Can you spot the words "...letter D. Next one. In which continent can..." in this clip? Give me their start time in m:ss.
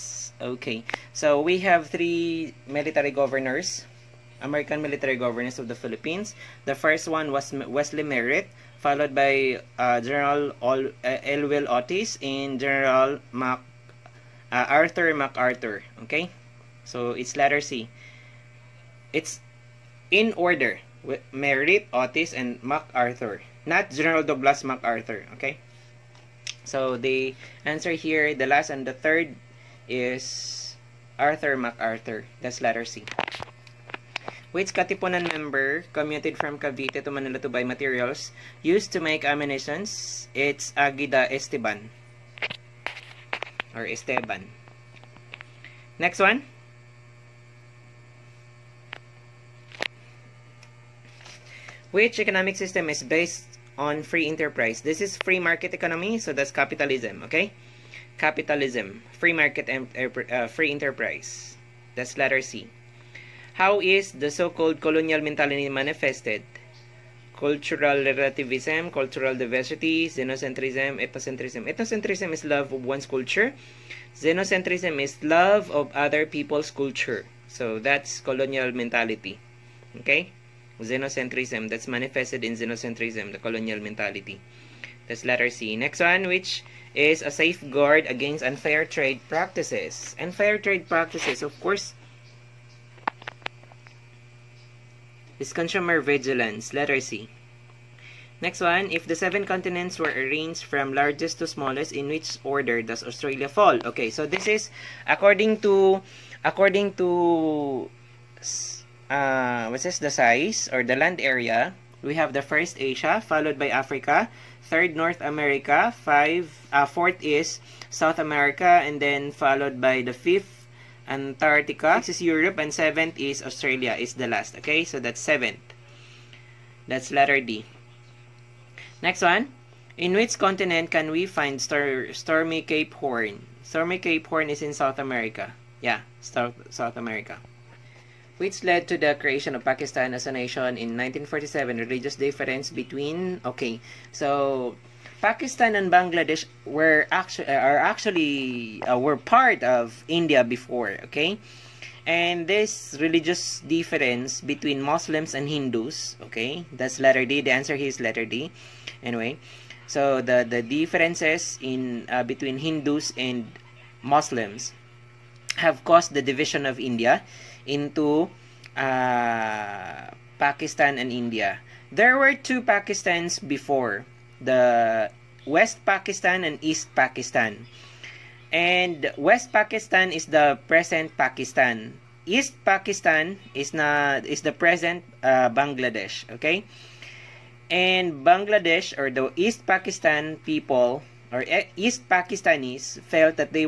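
2:07.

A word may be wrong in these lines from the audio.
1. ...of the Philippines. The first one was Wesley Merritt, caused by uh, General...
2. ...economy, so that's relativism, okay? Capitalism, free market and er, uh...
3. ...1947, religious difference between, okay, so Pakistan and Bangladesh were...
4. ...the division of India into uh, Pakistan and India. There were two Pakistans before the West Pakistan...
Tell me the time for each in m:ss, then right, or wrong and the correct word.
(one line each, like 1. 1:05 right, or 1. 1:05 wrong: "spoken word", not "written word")
1. 0:05 wrong: "followed", not "caused"
2. 0:55 wrong: "capitalism", not "relativism"
3. 2:20 right
4. 2:46 right.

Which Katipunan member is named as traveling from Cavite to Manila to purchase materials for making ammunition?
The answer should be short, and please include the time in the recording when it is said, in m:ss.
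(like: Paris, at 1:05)
Agueda Esteban, at 0:40.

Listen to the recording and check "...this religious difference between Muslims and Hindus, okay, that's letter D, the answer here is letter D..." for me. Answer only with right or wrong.
right.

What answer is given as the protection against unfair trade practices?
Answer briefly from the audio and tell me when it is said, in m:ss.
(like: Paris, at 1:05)
Consumer vigilance, at 1:35.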